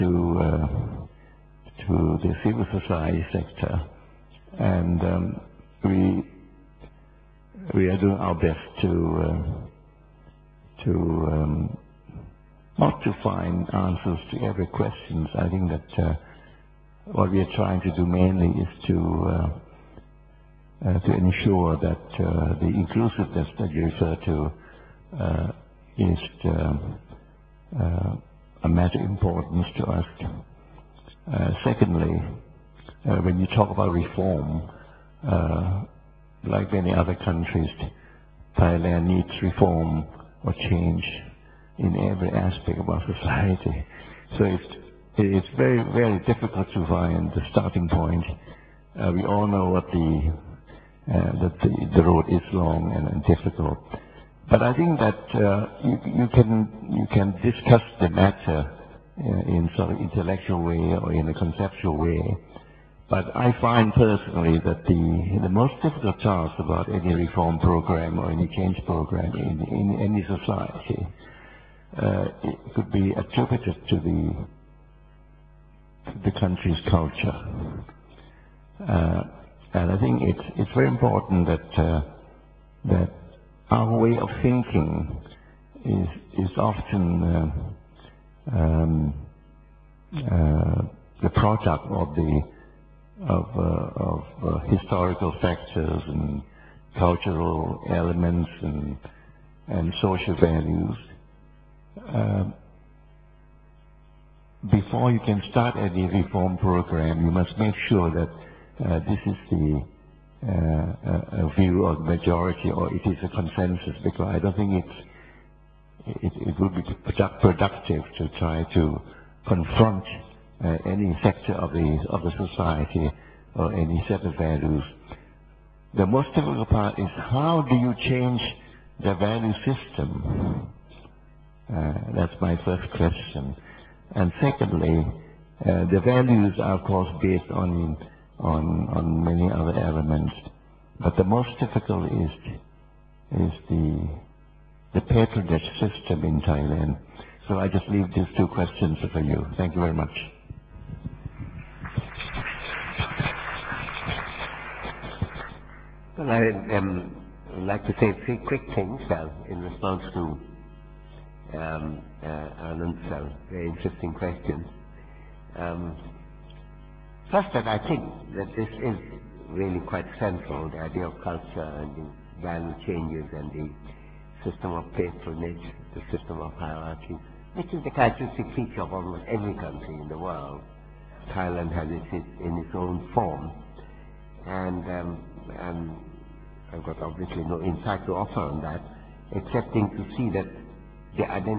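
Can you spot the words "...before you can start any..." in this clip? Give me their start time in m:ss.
1:44.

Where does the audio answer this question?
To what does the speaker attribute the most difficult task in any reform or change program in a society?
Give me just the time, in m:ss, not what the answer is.
1:16.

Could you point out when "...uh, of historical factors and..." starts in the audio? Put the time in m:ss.
1:33.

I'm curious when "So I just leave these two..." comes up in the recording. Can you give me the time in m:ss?
2:27.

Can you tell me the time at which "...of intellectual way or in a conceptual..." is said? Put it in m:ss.
0:59.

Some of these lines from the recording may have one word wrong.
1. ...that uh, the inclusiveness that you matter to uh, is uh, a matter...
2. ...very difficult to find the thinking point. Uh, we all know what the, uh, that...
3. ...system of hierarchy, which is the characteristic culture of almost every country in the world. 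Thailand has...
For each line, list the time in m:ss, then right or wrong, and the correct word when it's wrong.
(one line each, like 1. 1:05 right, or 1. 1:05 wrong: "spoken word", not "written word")
1. 0:21 wrong: "refer", not "matter"
2. 0:45 wrong: "starting", not "thinking"
3. 2:56 wrong: "feature", not "culture".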